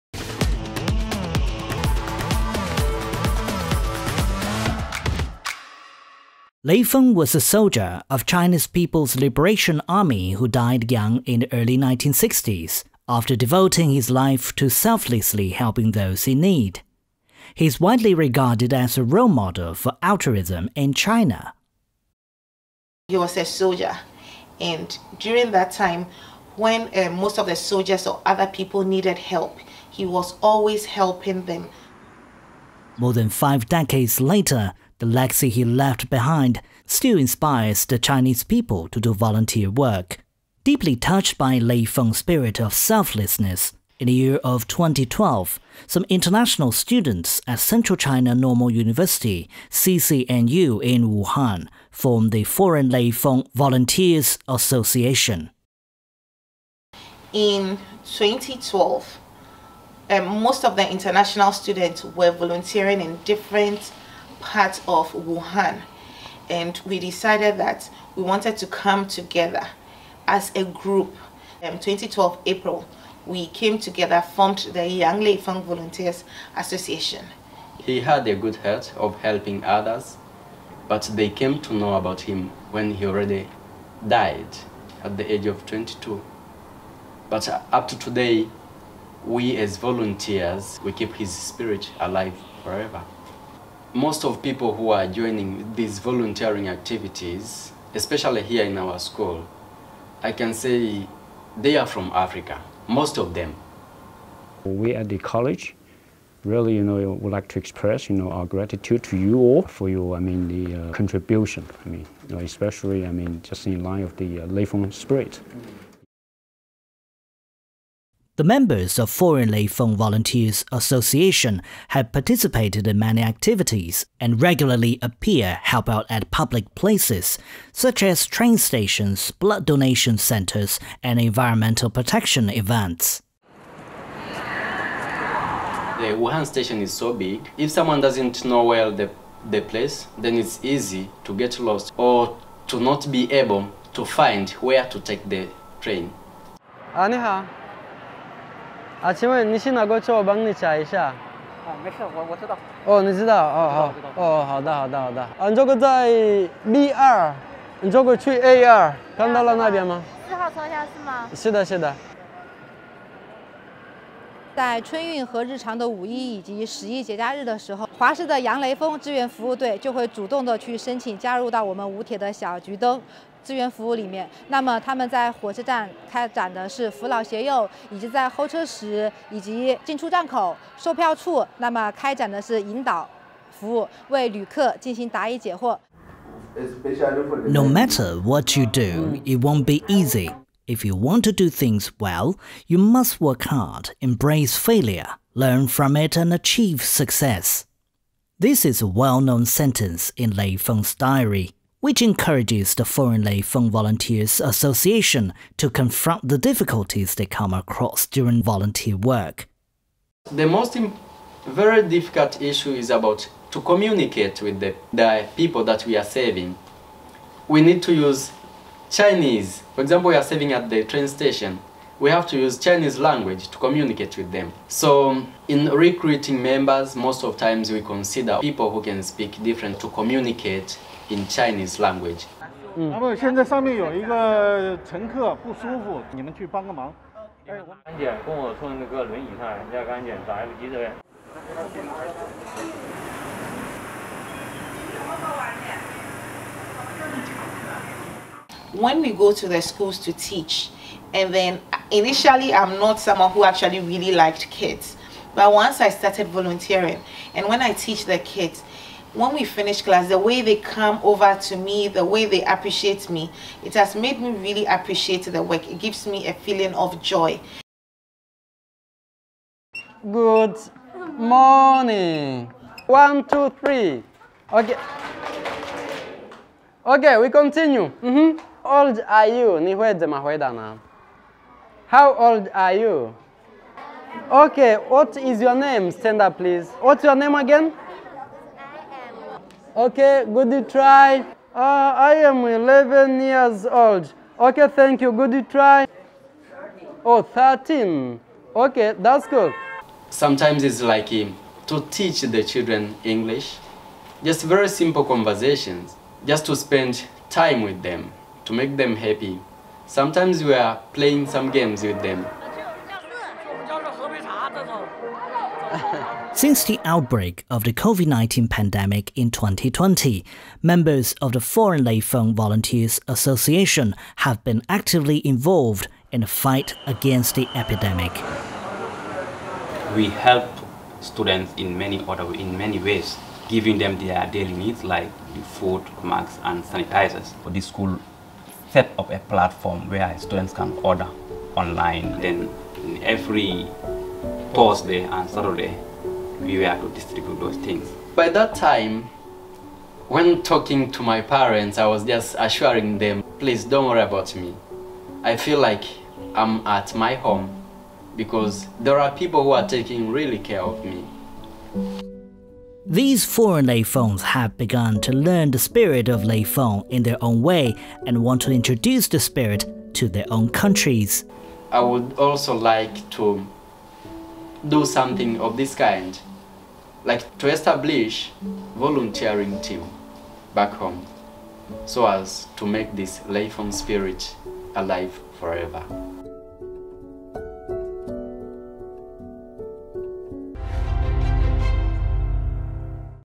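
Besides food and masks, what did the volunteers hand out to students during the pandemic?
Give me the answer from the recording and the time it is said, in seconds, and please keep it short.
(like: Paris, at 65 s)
Sanitizers, at 336 s.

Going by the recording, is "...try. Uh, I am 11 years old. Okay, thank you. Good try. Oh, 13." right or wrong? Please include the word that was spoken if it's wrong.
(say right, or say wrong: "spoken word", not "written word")
right.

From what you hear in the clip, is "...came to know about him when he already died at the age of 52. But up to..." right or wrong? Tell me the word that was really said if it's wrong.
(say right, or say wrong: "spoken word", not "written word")
wrong: "22", not "52".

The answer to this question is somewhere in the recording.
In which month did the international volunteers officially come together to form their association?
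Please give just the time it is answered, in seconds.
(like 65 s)
72 s.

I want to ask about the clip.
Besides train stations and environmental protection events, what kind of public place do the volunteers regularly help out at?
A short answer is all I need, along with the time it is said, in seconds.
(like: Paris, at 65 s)
Blood donation centers, at 129 s.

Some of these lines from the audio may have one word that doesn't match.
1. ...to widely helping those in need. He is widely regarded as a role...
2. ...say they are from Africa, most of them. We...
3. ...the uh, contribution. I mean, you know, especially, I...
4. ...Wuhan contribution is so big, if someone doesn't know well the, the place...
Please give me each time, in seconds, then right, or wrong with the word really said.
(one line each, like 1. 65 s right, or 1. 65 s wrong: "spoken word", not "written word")
1. 14 s wrong: "selflessly", not "widely"
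2. 100 s right
3. 110 s right
4. 136 s wrong: "station", not "contribution".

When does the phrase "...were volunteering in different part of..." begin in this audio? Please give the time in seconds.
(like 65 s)
62 s.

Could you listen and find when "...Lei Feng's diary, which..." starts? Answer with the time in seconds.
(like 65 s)
200 s.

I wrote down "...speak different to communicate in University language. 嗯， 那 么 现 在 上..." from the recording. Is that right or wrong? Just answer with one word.
wrong.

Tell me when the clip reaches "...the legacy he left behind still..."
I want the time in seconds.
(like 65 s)
35 s.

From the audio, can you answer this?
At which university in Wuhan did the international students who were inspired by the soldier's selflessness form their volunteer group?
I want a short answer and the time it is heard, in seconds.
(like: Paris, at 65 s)
Central China Normal University, at 47 s.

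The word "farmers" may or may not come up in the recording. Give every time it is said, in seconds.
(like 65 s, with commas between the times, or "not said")
not said.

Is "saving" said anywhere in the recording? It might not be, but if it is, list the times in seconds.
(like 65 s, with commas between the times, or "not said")
216 s, 220 s.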